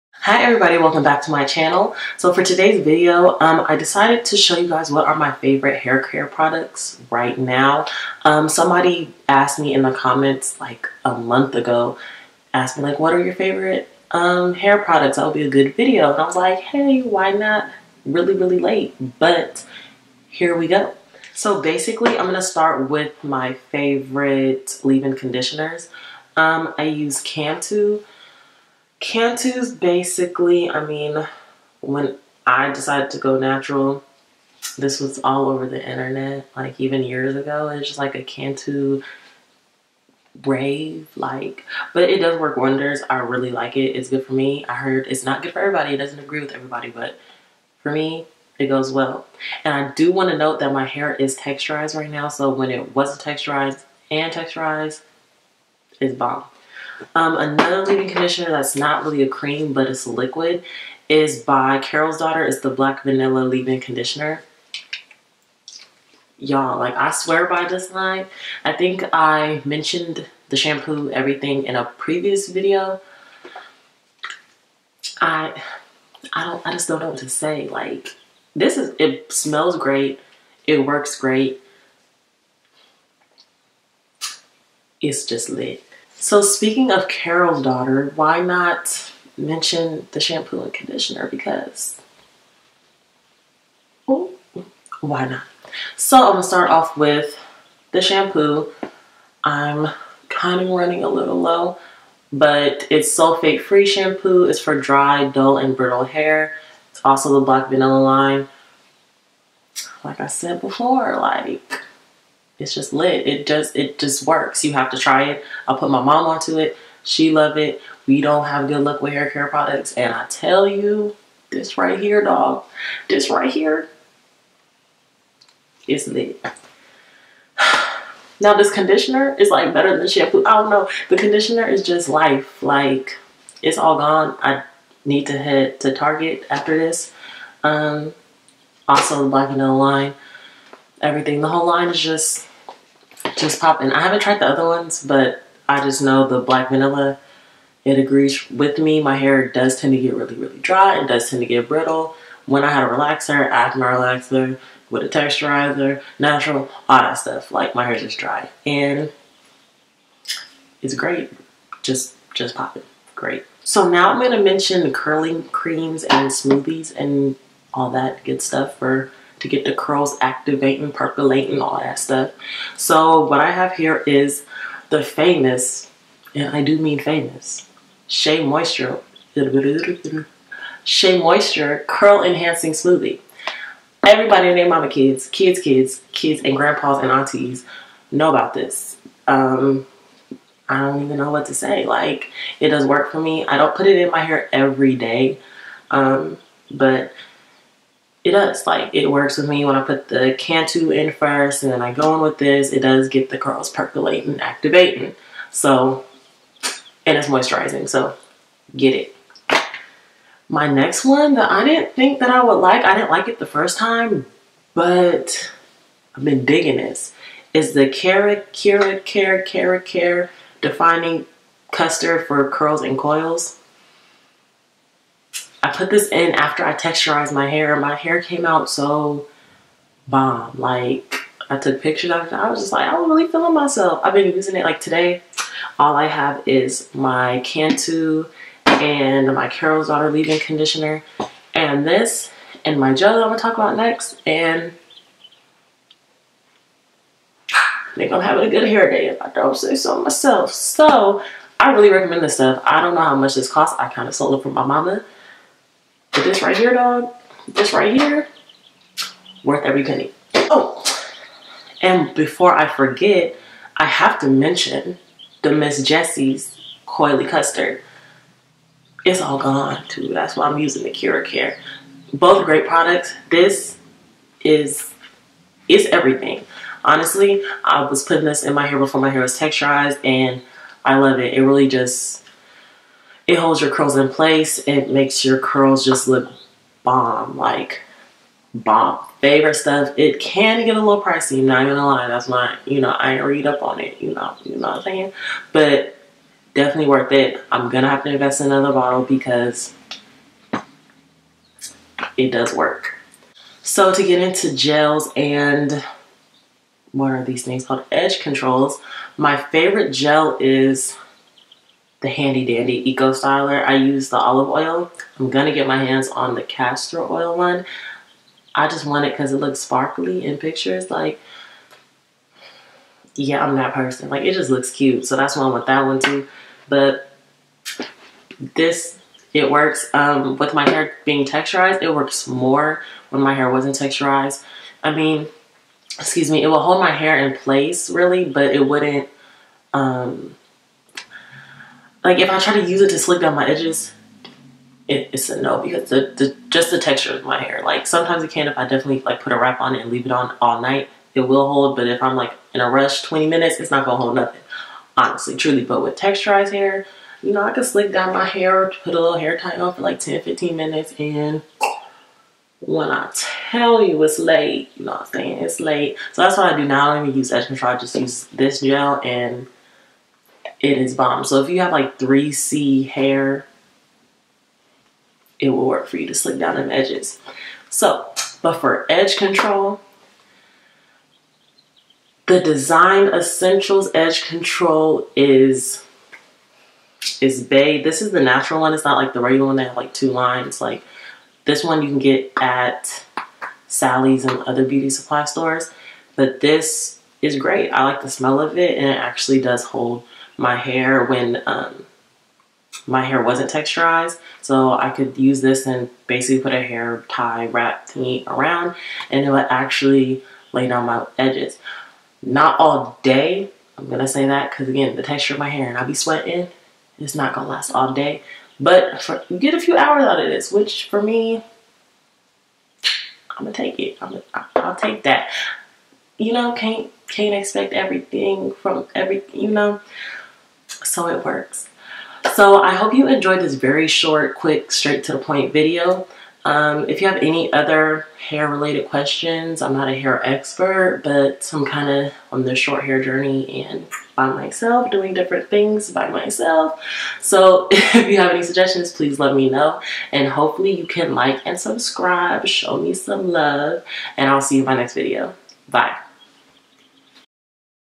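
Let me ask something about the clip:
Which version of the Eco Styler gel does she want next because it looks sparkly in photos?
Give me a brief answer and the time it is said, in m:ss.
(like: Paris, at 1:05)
castor oil, at 5:16.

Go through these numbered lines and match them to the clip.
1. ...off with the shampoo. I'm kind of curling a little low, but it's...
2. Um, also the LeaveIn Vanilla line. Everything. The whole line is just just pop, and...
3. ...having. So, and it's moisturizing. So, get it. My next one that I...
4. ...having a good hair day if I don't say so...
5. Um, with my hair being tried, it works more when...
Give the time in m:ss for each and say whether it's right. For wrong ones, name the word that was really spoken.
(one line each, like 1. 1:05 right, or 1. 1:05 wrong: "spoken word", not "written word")
1. 1:36 wrong: "running", not "curling"
2. 2:17 wrong: "Black", not "LeaveIn"
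3. 3:24 wrong: "activating", not "having"
4. 4:08 right
5. 5:29 wrong: "texturized", not "tried".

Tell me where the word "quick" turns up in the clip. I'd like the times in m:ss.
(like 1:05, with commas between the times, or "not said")
7:14.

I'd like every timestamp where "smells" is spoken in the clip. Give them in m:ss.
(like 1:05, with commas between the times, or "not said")
1:19, 6:38.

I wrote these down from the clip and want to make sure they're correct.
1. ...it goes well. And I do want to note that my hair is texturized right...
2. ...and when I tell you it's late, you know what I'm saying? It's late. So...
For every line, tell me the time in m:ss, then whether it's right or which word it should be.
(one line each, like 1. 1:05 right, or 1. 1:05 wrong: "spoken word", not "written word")
1. 0:48 right
2. 6:00 right.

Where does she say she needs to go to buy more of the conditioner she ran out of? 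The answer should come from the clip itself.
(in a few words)
Target.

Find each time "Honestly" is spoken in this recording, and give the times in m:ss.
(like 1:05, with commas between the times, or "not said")
4:36, 5:54.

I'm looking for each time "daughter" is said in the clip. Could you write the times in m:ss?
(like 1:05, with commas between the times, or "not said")
1:02, 1:27, 3:59.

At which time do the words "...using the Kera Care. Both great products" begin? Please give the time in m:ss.
4:30.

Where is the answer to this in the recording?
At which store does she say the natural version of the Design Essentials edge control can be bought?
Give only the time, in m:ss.
6:32.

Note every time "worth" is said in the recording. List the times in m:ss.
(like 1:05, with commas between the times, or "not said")
4:19, 4:56.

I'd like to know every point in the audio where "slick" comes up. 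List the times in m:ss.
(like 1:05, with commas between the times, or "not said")
5:42, 5:57, 6:16.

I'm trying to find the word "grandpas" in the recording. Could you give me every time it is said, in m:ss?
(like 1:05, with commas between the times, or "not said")
3:06.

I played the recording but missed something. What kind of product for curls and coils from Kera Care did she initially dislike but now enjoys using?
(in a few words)
Defining Custard.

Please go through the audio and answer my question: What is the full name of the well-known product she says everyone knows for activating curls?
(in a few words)
Curl Enhancing Smoothie.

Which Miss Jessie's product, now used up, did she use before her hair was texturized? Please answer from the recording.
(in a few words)
Coily Custard.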